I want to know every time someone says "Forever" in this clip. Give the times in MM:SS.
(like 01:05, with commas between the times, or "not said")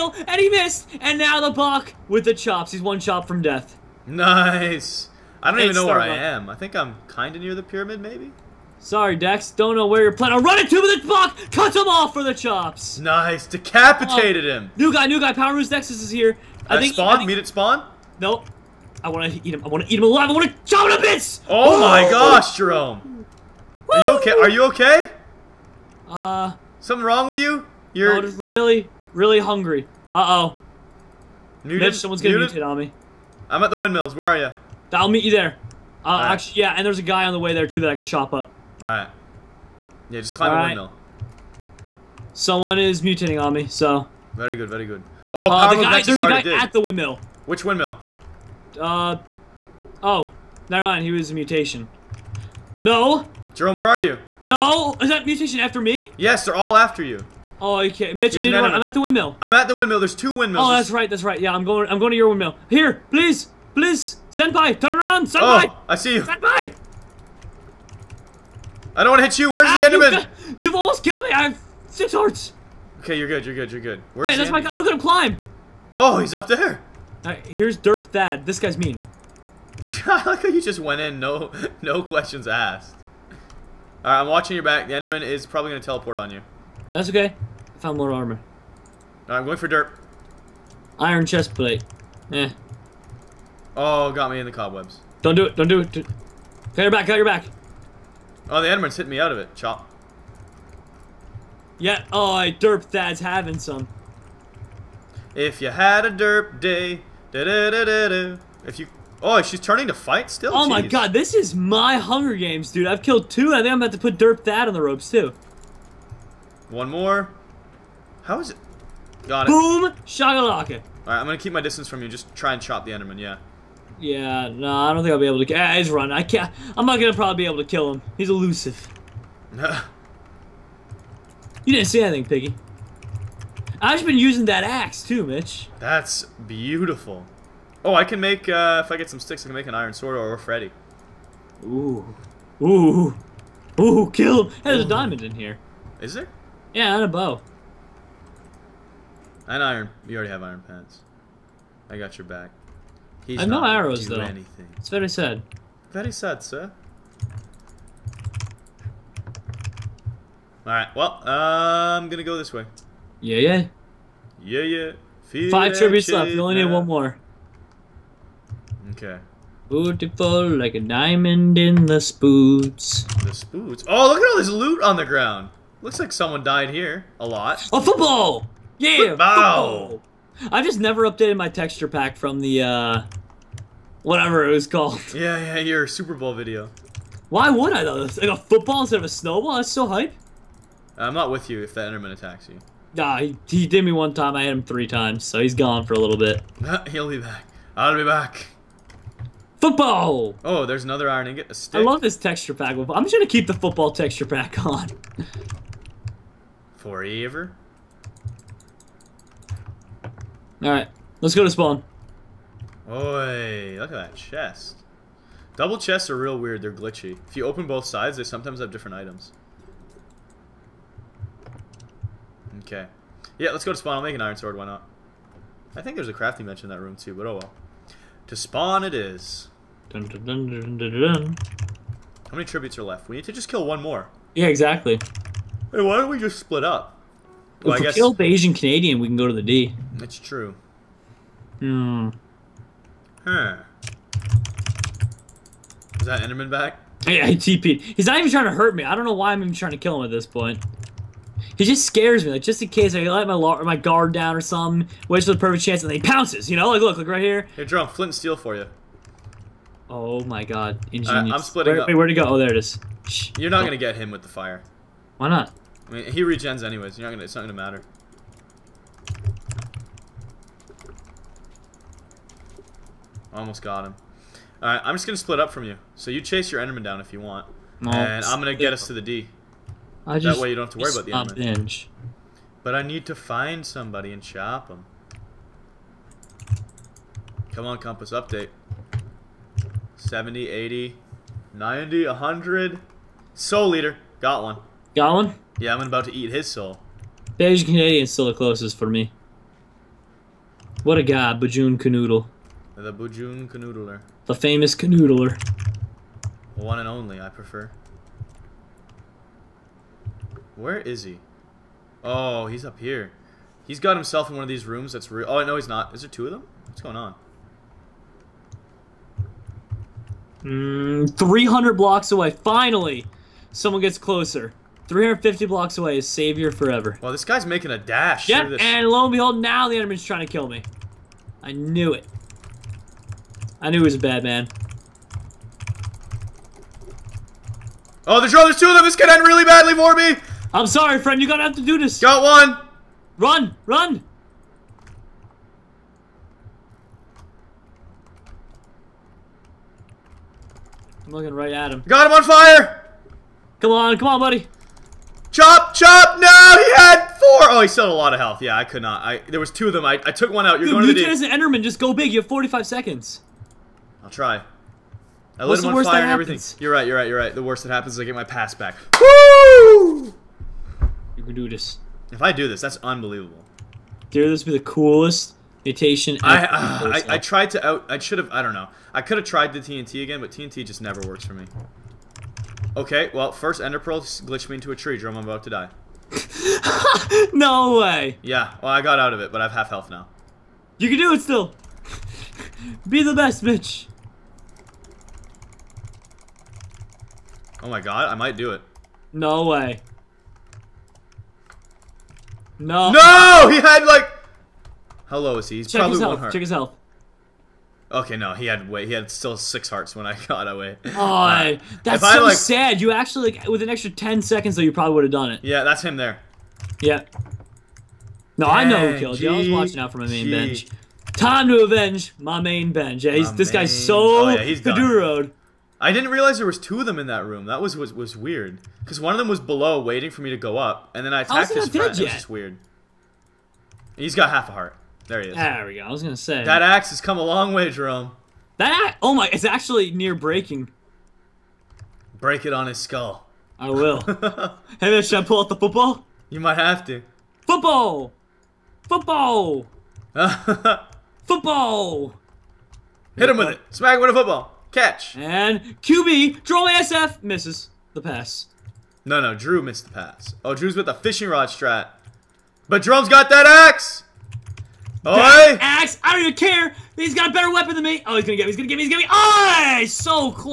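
03:26, 05:26.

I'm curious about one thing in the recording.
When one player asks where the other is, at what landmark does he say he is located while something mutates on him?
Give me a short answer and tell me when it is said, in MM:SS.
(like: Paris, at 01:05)
The windmills, at 00:33.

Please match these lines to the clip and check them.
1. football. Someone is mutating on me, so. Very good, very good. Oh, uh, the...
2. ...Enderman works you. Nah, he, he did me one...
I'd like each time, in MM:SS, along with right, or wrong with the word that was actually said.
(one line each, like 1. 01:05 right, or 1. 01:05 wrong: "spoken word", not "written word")
1. 00:40 wrong: "windmill", not "football"
2. 03:11 wrong: "attacks", not "works".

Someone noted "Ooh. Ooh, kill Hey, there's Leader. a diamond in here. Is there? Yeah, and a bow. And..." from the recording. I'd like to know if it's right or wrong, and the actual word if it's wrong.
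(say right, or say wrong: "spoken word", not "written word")
wrong: "Ooh", not "Leader".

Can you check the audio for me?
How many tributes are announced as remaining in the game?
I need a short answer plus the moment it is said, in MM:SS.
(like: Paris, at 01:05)
5, at 02:45.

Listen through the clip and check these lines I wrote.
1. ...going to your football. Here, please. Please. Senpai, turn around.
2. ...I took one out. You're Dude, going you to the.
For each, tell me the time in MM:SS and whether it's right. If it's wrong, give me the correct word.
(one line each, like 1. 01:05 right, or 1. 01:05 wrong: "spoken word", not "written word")
1. 01:01 wrong: "windmill", not "football"
2. 06:00 right.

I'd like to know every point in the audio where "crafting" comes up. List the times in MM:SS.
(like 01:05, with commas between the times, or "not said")
03:46.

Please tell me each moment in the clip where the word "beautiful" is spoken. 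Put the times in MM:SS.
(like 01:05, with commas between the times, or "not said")
02:16, 02:49.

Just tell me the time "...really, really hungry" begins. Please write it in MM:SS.
00:28.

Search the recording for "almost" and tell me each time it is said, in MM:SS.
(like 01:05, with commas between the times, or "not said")
01:10, 04:33.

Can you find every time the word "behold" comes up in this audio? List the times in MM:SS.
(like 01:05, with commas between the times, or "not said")
05:29.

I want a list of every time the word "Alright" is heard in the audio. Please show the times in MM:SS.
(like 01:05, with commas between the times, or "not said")
01:24, 02:00, 02:40, 03:30.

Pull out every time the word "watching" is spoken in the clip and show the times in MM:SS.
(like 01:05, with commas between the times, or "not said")
01:24, 06:59.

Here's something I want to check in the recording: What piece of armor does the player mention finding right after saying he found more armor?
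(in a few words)
Iron chest plate.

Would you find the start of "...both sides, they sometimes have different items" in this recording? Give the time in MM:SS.
03:37.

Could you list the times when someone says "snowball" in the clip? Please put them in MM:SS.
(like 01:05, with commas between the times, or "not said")
03:09.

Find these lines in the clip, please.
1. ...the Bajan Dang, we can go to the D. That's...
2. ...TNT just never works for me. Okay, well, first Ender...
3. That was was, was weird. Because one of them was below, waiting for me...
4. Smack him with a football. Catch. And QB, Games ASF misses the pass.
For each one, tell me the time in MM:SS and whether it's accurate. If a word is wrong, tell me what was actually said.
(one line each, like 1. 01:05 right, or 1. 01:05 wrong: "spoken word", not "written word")
1. 03:58 wrong: "Canadian", not "Dang"
2. 06:20 right
3. 07:07 right
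4. 07:33 wrong: "Droll", not "Games".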